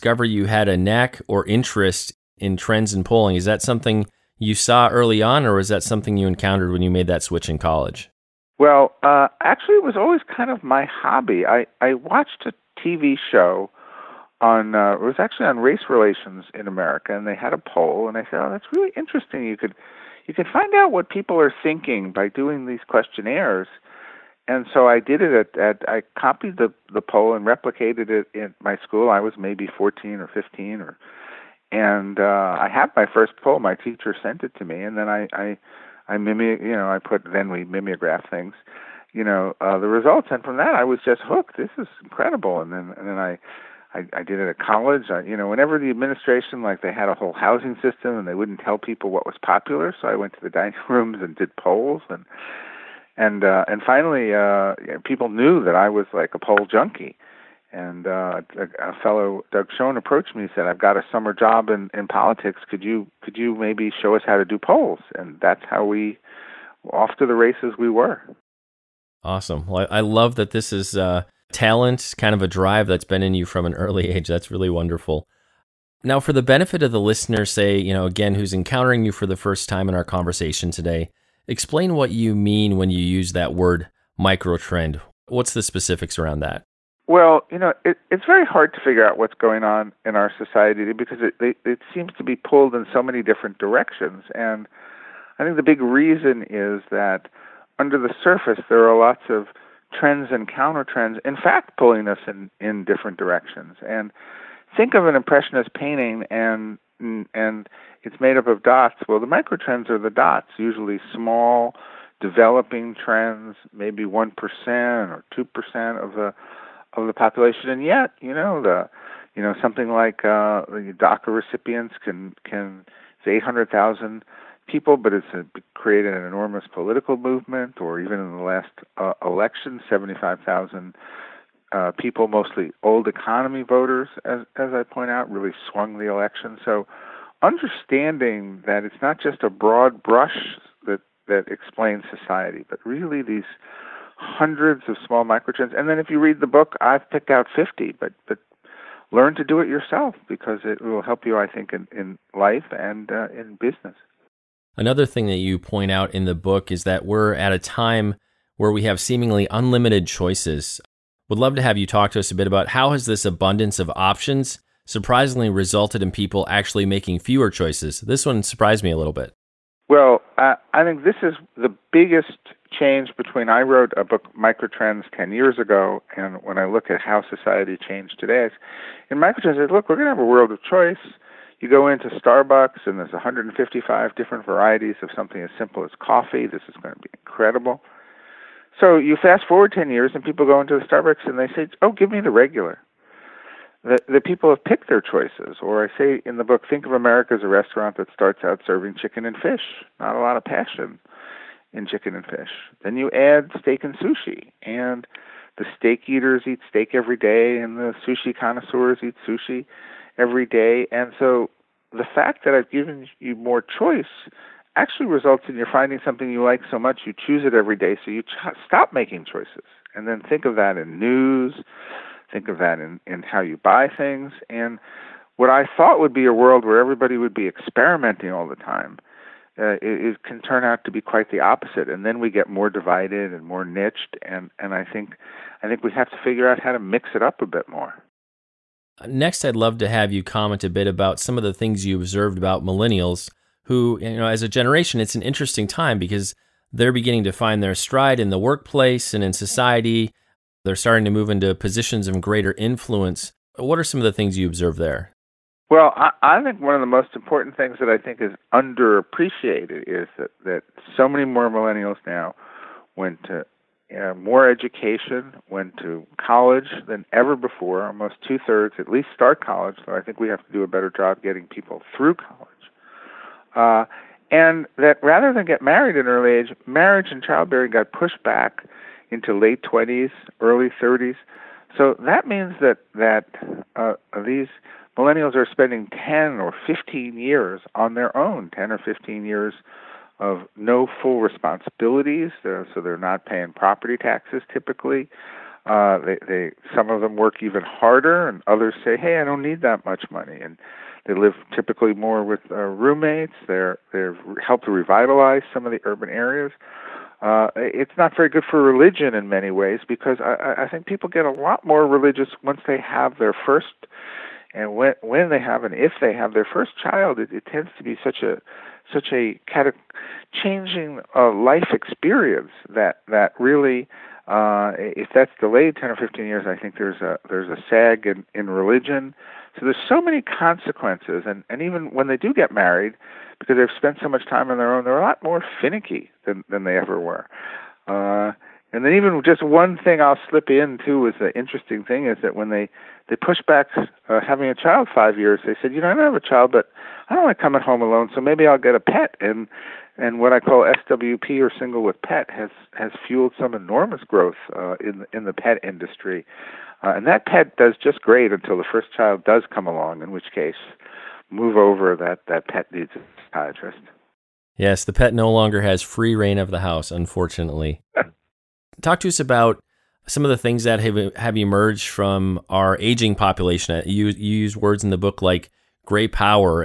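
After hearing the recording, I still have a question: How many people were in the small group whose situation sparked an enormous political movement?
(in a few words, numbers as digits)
800,000.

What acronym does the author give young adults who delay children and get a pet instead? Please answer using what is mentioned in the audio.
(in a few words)
SWP.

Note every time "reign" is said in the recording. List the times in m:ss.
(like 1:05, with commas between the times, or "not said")
6:06.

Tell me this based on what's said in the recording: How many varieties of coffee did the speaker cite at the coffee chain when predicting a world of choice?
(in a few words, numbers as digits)
155.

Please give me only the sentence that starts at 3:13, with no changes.
The, the people have picked their choices.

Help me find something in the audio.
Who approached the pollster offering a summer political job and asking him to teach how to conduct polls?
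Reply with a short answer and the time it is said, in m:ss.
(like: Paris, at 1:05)
Doug Schoen, at 0:59.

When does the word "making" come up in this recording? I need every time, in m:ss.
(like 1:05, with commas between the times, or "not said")
2:46, 3:38.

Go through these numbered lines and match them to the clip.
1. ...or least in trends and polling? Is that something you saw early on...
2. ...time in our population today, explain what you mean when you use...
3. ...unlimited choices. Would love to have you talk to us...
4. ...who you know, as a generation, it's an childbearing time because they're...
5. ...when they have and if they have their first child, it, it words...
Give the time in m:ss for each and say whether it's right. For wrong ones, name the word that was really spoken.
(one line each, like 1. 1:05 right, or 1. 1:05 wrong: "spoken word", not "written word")
1. 0:01 wrong: "interest", not "least"
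2. 1:19 wrong: "conversation", not "population"
3. 2:39 right
4. 4:03 wrong: "interesting", not "childbearing"
5. 5:15 wrong: "tends", not "words".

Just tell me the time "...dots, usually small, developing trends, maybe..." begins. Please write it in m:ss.
1:50.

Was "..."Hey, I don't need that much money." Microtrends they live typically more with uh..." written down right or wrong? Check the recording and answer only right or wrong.
wrong.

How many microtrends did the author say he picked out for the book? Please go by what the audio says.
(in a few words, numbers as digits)
50.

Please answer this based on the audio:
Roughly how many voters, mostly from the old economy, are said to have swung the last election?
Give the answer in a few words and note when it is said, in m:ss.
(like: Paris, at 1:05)
75,000, at 2:09.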